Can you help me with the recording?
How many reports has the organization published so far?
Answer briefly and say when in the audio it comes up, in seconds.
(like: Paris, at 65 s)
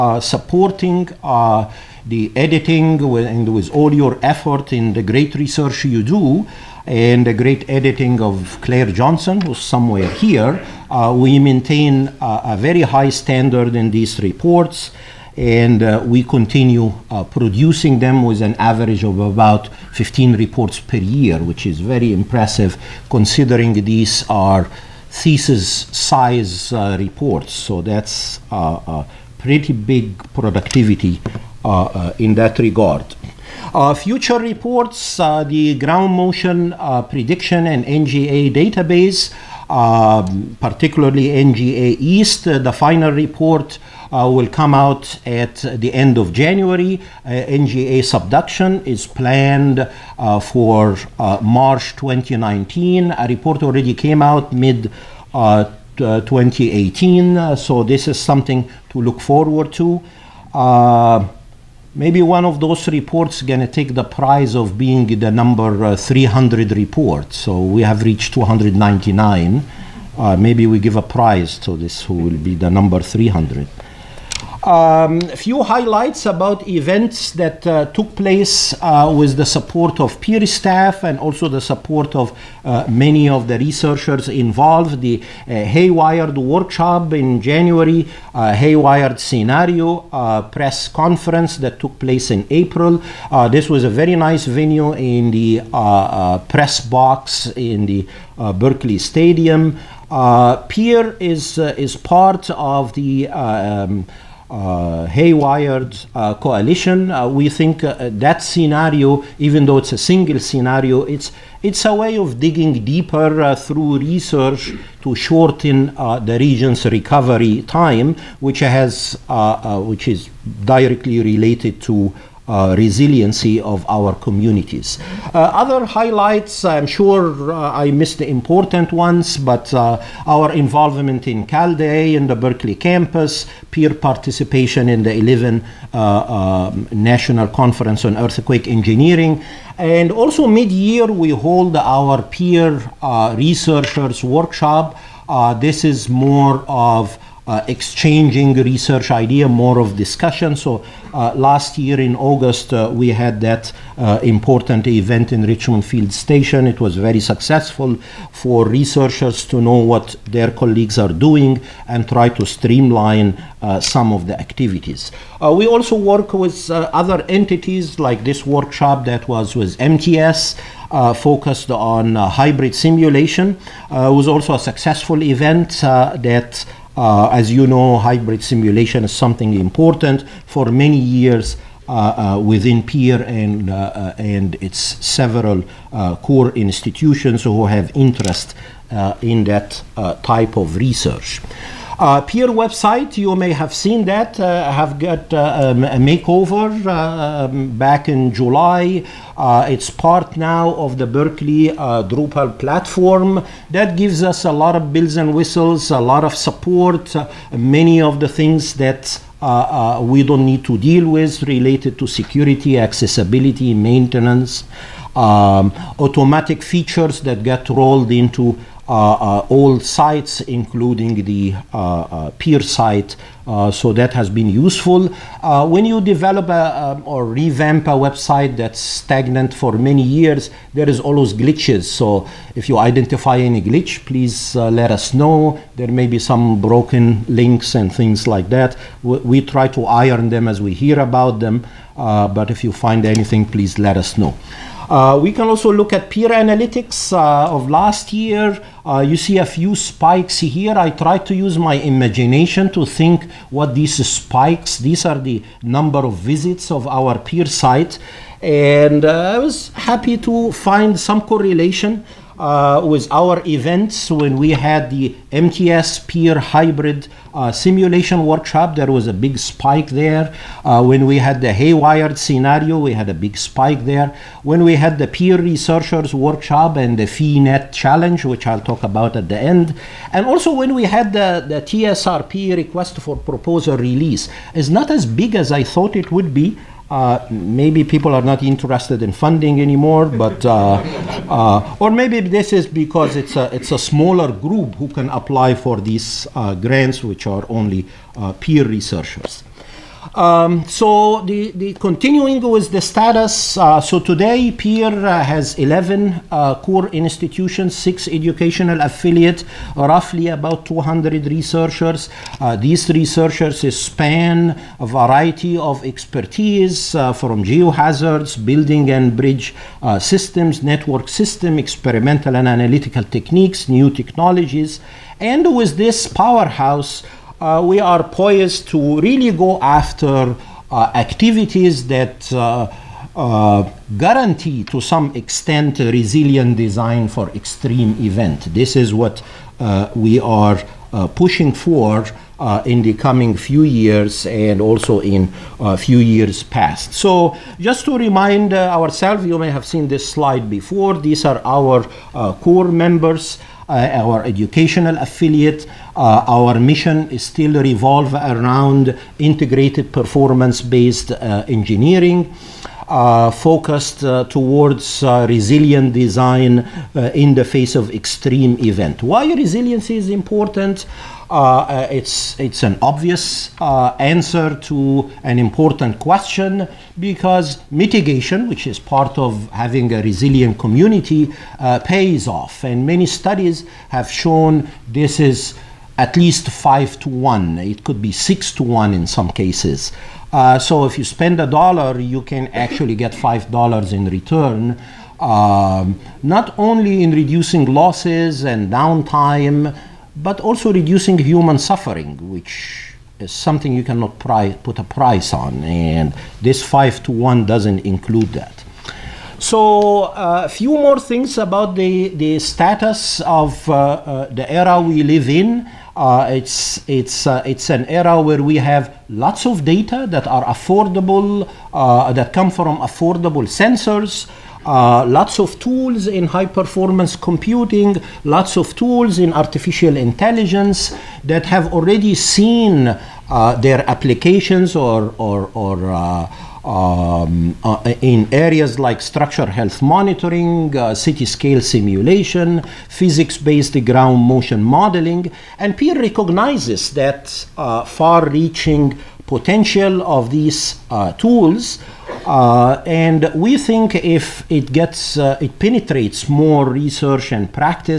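299, at 68 s.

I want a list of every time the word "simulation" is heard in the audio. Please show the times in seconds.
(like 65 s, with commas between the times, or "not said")
172 s, 178 s, 267 s, 441 s.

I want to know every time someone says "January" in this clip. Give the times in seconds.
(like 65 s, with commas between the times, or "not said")
46 s, 87 s.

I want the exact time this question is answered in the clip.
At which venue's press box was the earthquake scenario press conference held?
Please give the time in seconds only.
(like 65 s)
98 s.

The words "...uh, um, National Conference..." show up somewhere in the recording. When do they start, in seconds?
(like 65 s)
135 s.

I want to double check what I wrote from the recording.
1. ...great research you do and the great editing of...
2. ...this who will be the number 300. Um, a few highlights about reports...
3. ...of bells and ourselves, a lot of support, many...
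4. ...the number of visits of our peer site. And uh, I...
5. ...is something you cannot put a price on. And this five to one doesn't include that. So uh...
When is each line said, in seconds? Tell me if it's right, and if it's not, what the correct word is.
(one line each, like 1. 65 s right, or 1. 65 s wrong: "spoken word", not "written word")
1. 5 s right
2. 71 s wrong: "events", not "reports"
3. 204 s wrong: "whistles", not "ourselves"
4. 255 s right
5. 403 s right.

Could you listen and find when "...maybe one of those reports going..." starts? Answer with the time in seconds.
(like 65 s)
61 s.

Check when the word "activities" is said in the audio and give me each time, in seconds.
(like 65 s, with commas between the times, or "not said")
164 s, 330 s.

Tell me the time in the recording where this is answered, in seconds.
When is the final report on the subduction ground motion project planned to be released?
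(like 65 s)
51 s.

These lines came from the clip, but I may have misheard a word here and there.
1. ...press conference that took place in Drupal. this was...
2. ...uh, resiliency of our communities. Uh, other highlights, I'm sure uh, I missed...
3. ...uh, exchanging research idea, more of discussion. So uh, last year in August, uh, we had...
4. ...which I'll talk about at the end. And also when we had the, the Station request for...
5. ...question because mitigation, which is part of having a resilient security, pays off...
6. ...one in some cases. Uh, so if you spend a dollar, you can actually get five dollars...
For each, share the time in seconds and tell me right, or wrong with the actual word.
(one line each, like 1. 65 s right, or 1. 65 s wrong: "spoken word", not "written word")
1. 90 s wrong: "April", not "Drupal"
2. 122 s right
3. 147 s right
4. 278 s wrong: "TSRP", not "Station"
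5. 375 s wrong: "community", not "security"
6. 388 s right.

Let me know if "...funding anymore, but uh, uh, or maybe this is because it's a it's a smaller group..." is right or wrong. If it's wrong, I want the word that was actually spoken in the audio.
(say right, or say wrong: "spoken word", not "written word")
right.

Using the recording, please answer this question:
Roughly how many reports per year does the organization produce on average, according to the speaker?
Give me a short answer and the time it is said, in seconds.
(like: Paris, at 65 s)
15, at 19 s.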